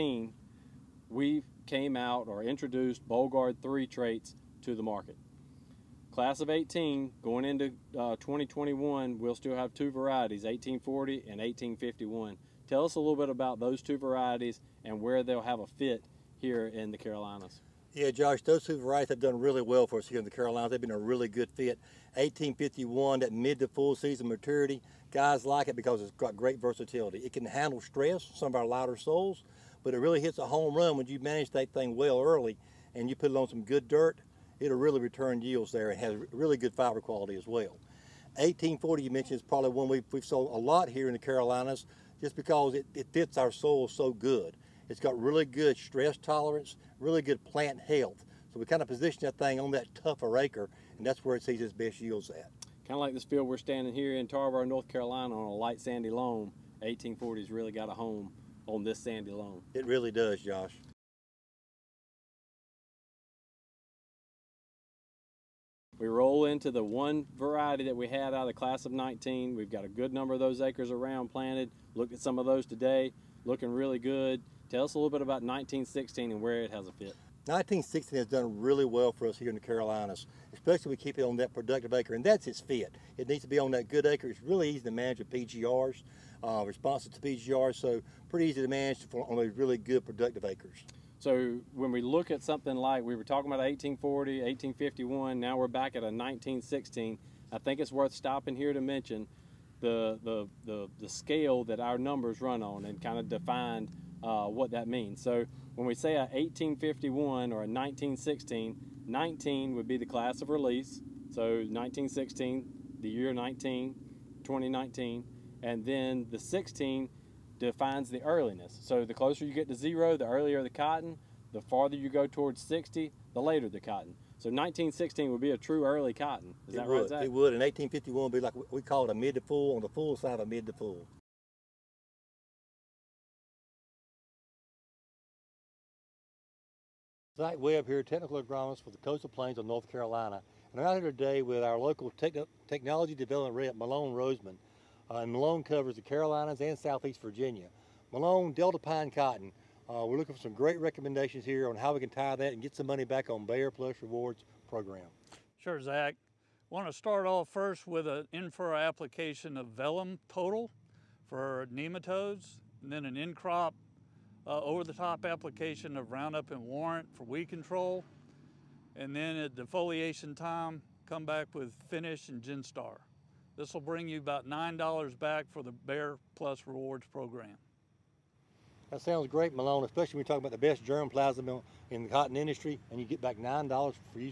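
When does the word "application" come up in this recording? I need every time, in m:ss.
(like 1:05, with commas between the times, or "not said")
2:38, 2:45.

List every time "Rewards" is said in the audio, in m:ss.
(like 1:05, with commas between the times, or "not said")
2:34, 2:56.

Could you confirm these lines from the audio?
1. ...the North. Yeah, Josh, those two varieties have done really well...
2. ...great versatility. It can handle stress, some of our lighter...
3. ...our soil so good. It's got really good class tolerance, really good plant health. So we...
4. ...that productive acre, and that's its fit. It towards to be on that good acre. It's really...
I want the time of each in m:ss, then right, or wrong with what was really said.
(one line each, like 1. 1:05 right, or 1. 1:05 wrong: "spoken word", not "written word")
1. 0:16 wrong: "Carolinas", not "North"
2. 0:26 right
3. 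0:43 wrong: "stress", not "class"
4. 1:21 wrong: "needs", not "towards".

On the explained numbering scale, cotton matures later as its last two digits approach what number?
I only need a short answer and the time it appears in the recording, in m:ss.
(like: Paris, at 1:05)
60, at 2:02.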